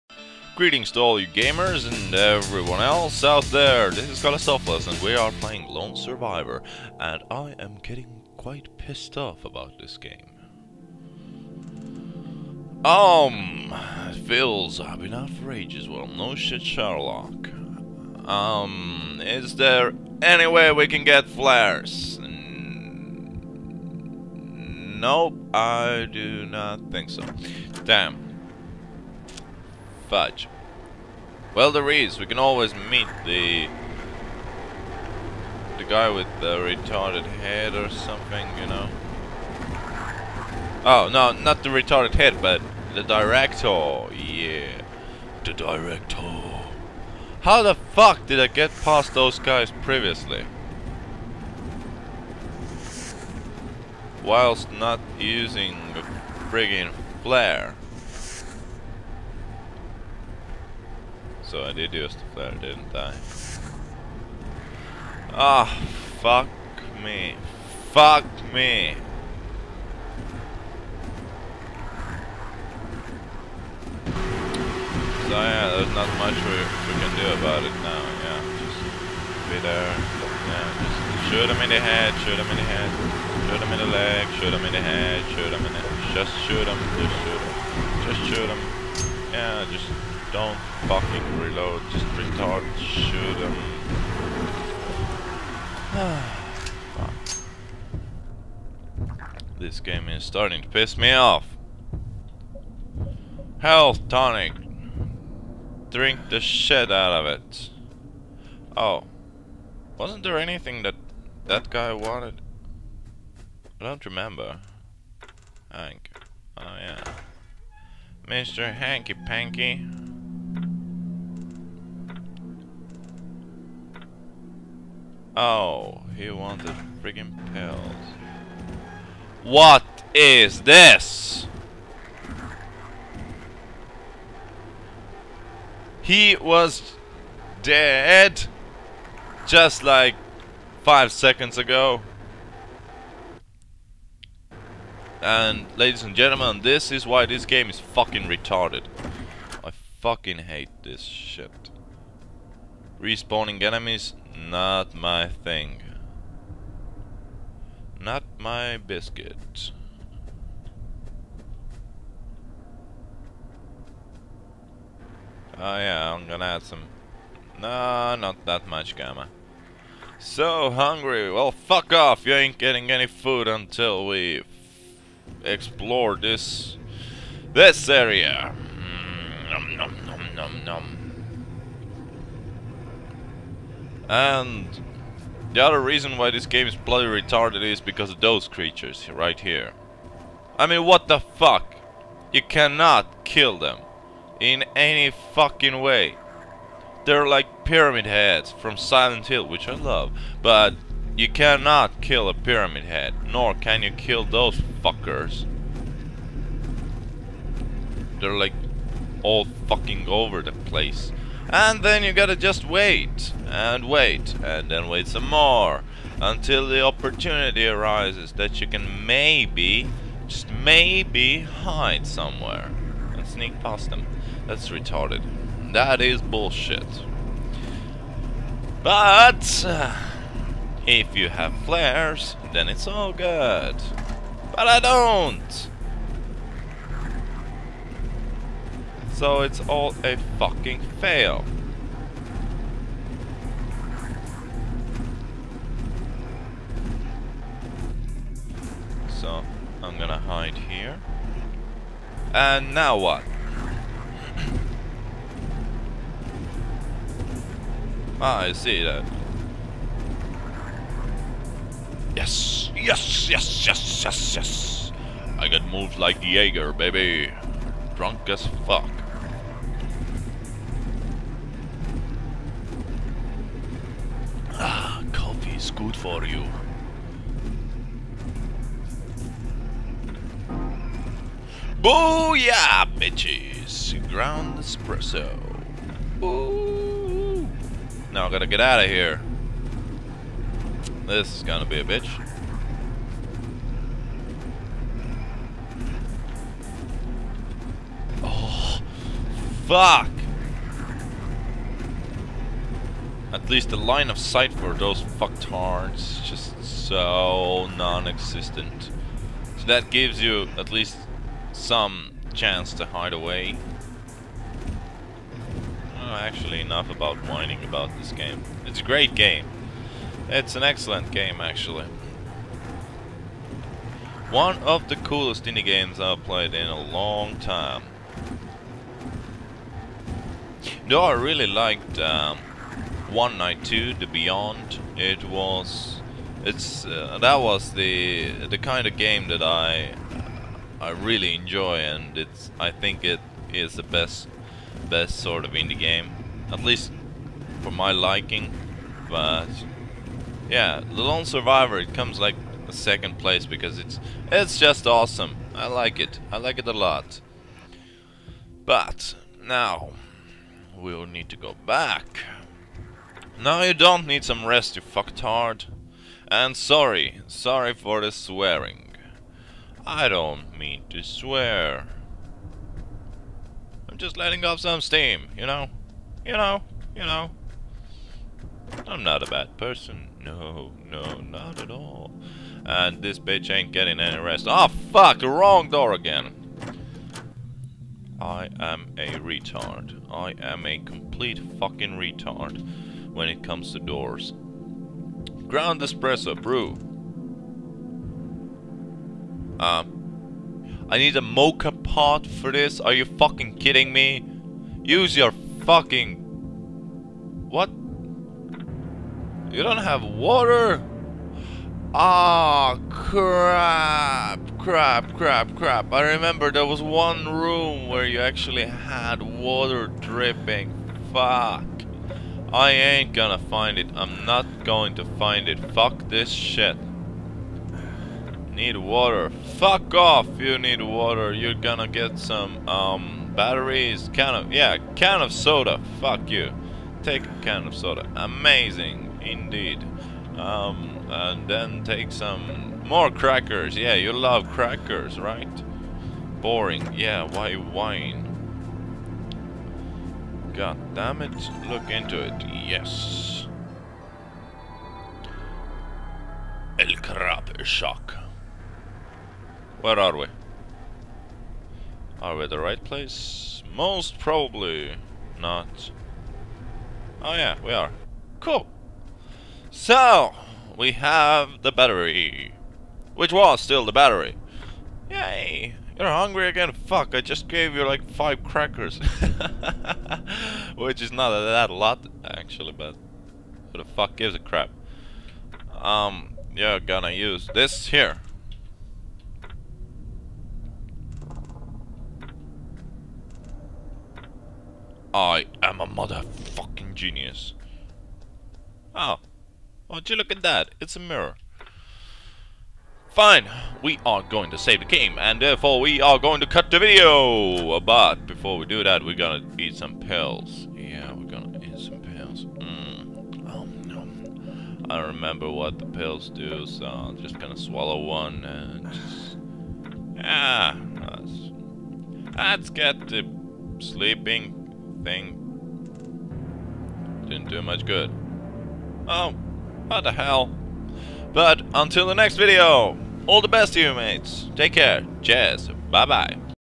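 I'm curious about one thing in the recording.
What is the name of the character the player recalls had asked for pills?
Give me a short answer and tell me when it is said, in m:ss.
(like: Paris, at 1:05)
Hank, at 1:55.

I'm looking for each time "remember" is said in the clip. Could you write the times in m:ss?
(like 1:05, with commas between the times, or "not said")
1:54, 6:56, 8:35.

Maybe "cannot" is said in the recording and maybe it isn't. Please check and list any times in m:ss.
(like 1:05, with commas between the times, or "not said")
3:12, 3:21.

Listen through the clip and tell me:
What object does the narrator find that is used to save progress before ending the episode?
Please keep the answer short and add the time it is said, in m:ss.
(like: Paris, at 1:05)
A mirror, at 8:20.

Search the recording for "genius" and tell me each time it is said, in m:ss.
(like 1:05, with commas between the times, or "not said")
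8:16.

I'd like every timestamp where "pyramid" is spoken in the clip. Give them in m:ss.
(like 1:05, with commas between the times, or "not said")
3:17, 3:22.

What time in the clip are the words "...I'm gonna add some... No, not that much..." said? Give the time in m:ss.
2:46.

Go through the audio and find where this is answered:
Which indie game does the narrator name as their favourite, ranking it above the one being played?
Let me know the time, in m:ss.
5:33.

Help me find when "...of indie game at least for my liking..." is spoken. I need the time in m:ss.
5:45.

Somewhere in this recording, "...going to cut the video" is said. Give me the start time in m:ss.
8:26.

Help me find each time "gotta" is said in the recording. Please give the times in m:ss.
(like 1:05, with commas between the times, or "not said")
3:32, 4:48.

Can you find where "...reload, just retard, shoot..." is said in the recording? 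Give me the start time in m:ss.
1:31.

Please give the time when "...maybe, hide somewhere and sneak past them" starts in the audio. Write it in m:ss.
3:40.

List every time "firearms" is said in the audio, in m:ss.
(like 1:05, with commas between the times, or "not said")
not said.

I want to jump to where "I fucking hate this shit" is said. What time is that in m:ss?
2:29.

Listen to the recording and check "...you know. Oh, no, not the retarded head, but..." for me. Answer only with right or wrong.
right.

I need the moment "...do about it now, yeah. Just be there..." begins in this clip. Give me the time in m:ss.
1:17.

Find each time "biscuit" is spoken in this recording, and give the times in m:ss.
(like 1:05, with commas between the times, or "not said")
2:38.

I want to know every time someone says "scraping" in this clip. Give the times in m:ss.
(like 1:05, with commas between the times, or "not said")
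not said.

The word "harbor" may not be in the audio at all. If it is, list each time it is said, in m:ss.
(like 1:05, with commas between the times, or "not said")
not said.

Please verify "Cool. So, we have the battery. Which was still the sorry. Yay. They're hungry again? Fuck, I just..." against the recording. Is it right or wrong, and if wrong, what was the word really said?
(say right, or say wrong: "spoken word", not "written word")
wrong: "battery", not "sorry".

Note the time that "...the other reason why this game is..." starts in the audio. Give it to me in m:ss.
3:05.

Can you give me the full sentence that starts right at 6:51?
Ah, oh, crap, crap, crap, crap.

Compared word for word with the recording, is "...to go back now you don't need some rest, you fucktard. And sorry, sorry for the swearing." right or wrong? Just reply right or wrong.
right.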